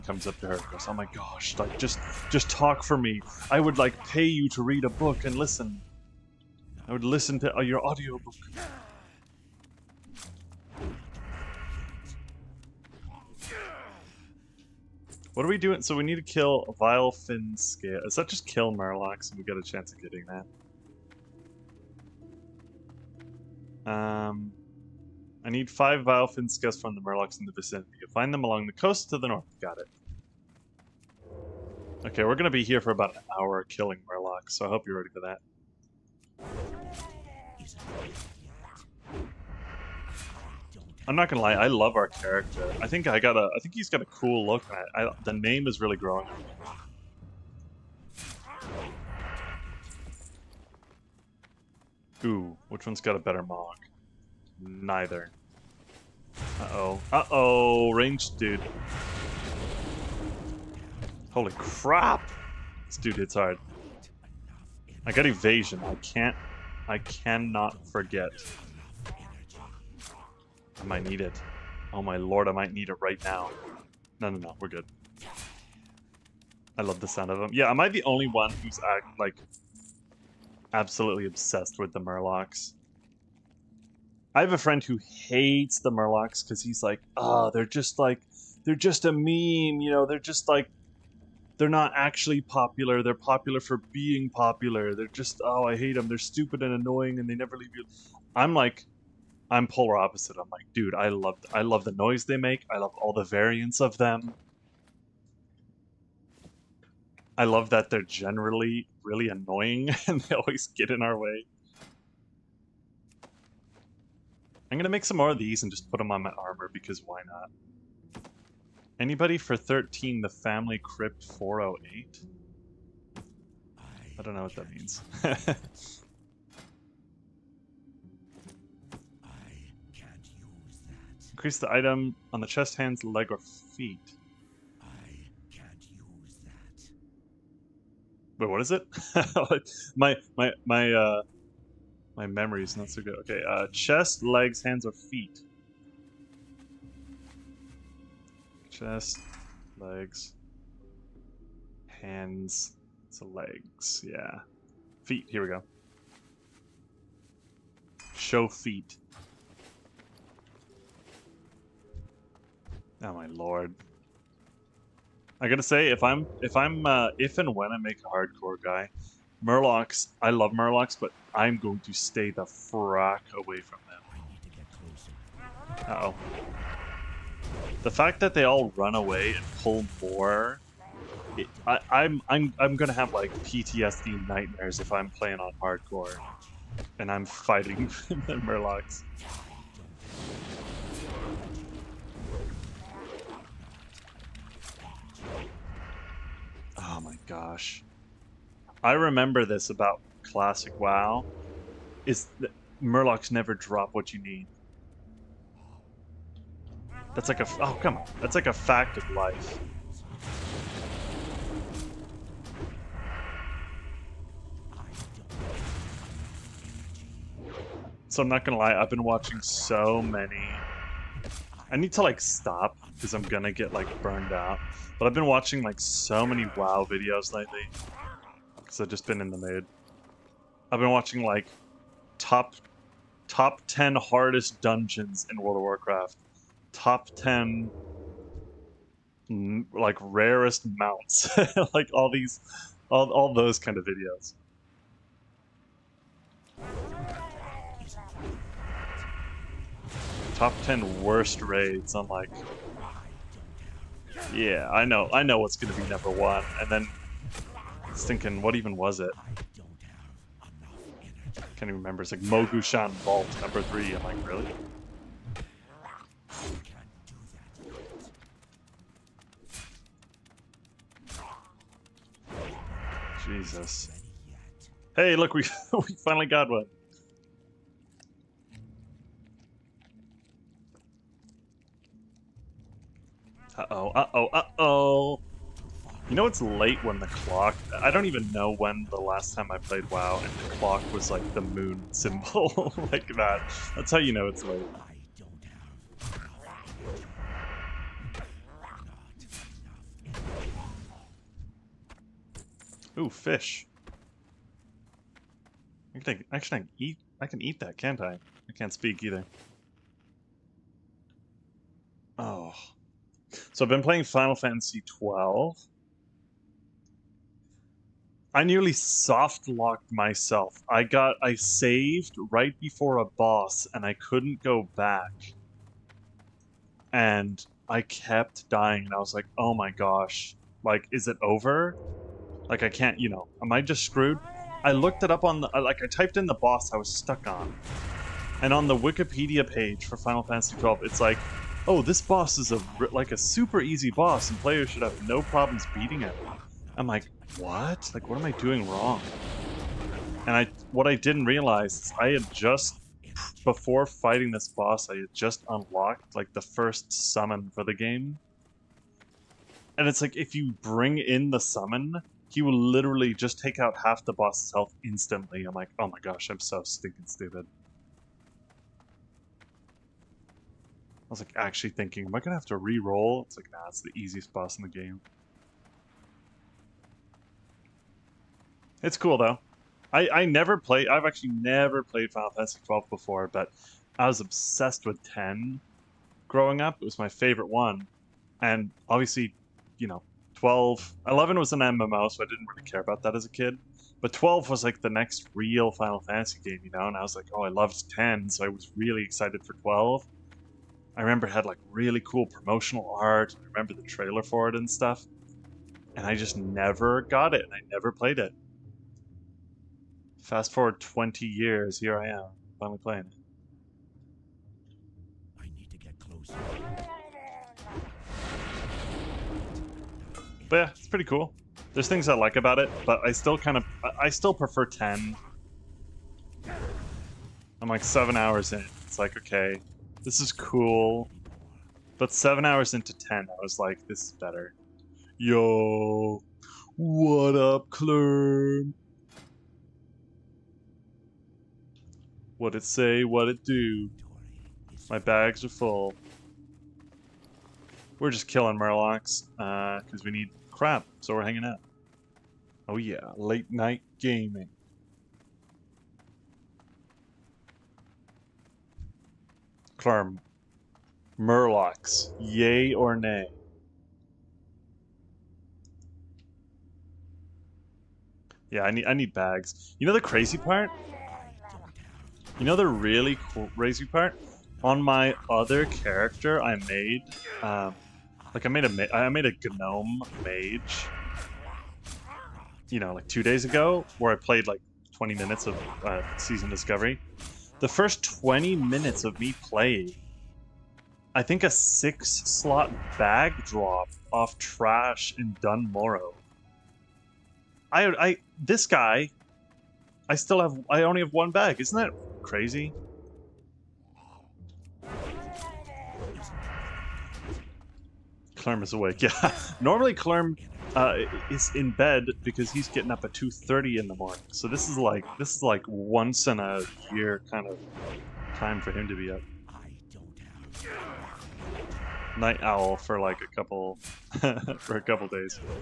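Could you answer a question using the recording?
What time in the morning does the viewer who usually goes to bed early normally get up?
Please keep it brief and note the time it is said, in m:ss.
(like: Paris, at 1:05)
2:30, at 8:33.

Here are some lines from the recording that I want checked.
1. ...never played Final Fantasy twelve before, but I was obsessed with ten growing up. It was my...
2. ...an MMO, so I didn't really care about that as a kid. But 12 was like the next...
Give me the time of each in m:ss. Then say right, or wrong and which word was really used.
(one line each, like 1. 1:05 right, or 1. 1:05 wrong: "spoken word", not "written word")
1. 6:21 right
2. 6:31 right.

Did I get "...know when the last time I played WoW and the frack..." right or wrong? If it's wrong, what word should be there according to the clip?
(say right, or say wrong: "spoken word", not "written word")
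wrong: "clock", not "frack".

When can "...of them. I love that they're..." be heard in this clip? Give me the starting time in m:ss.
1:43.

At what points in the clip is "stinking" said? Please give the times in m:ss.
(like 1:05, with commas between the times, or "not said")
6:06.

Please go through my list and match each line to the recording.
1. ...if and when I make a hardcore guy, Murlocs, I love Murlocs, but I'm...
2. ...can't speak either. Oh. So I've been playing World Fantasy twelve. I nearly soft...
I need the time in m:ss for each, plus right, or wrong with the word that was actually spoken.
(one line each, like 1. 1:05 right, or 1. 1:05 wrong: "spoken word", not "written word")
1. 2:47 right
2. 5:08 wrong: "Final", not "World".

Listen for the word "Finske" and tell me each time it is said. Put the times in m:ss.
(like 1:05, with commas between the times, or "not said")
0:17.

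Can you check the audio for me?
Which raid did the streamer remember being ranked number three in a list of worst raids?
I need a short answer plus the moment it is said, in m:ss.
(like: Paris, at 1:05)
Mogu'shan Vault, at 4:22.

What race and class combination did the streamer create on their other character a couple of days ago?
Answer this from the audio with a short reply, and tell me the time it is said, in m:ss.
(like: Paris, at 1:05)
gnome mage, at 7:59.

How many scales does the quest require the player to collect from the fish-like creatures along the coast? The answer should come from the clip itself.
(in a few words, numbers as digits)
5.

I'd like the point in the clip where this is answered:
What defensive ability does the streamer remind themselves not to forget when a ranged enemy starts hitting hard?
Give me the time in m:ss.
1:05.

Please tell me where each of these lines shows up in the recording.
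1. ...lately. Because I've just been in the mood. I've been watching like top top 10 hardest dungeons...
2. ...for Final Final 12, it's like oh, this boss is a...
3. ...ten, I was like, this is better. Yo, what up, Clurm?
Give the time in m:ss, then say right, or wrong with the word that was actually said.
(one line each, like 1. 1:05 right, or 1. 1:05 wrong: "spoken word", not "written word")
1. 3:47 right
2. 5:39 wrong: "Fantasy", not "Final"
3. 7:12 right.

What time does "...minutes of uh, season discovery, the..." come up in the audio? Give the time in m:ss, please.
8:05.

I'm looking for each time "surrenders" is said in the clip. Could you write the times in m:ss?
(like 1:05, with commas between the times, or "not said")
not said.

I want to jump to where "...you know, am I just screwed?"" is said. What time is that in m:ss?
5:32.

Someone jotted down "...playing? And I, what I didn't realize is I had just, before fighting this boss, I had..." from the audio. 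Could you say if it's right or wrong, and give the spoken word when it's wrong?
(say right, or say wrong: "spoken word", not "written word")
wrong: "wrong", not "playing".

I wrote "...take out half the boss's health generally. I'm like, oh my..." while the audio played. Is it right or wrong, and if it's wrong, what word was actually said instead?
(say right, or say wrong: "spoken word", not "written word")
wrong: "instantly", not "generally".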